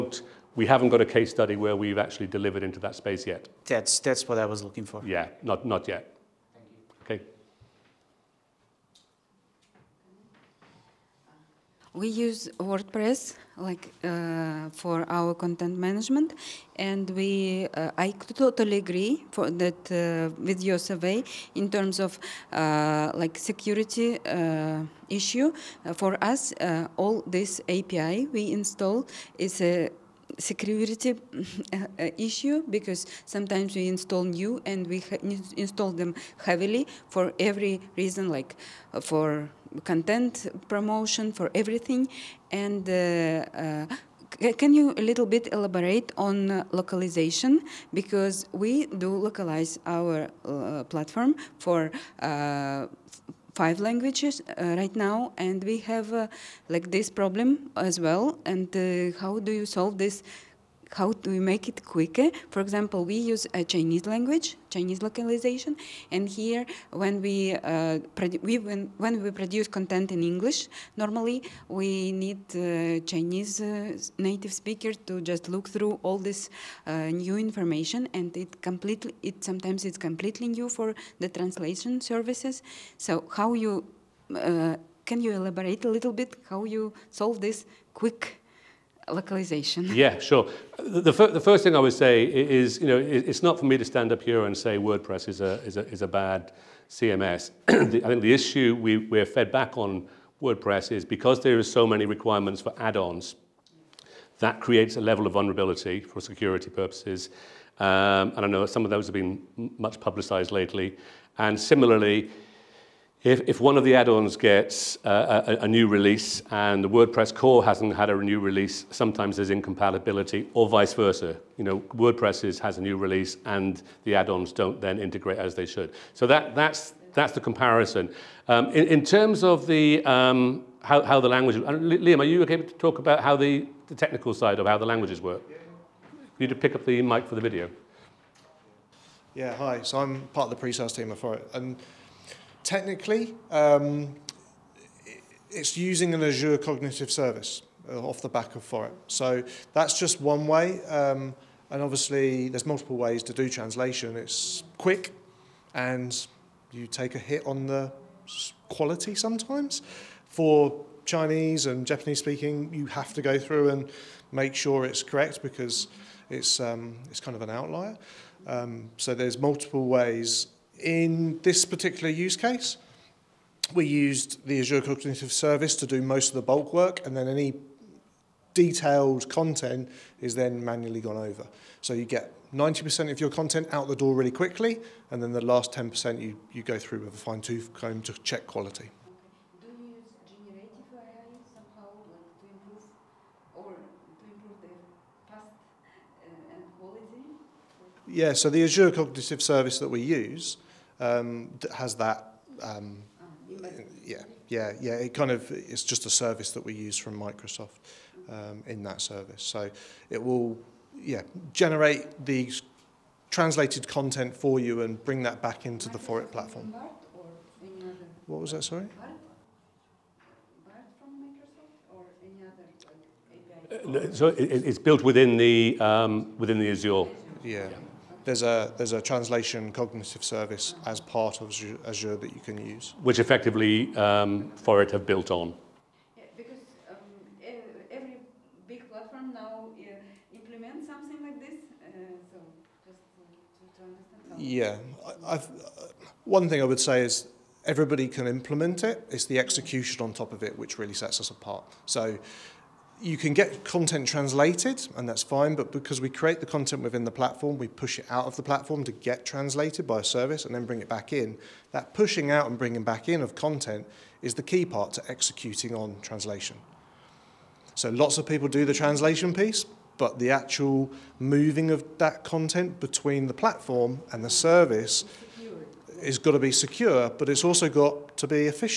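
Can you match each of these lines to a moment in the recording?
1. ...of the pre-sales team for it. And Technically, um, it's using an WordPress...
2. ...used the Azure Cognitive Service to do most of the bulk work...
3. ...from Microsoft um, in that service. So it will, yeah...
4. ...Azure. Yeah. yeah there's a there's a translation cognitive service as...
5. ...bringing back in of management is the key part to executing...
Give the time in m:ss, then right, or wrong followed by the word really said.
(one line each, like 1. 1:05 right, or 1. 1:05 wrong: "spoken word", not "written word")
1. 2:20 wrong: "Azure", not "WordPress"
2. 2:53 right
3. 3:26 right
4. 3:46 right
5. 4:22 wrong: "content", not "management".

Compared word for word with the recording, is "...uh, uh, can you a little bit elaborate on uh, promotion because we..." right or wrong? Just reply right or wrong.
wrong.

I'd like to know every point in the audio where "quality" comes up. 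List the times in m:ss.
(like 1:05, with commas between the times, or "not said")
2:38, 3:08, 3:16.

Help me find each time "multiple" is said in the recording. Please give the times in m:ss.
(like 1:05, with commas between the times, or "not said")
2:32, 2:49.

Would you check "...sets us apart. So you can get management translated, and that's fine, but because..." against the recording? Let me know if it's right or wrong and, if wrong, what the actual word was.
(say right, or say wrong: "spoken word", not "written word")
wrong: "content", not "management".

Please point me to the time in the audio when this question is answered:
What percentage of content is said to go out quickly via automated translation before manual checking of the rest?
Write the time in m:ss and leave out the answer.
3:02.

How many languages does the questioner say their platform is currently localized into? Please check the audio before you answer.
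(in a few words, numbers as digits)
5.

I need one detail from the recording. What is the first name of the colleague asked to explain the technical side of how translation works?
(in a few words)
Liam.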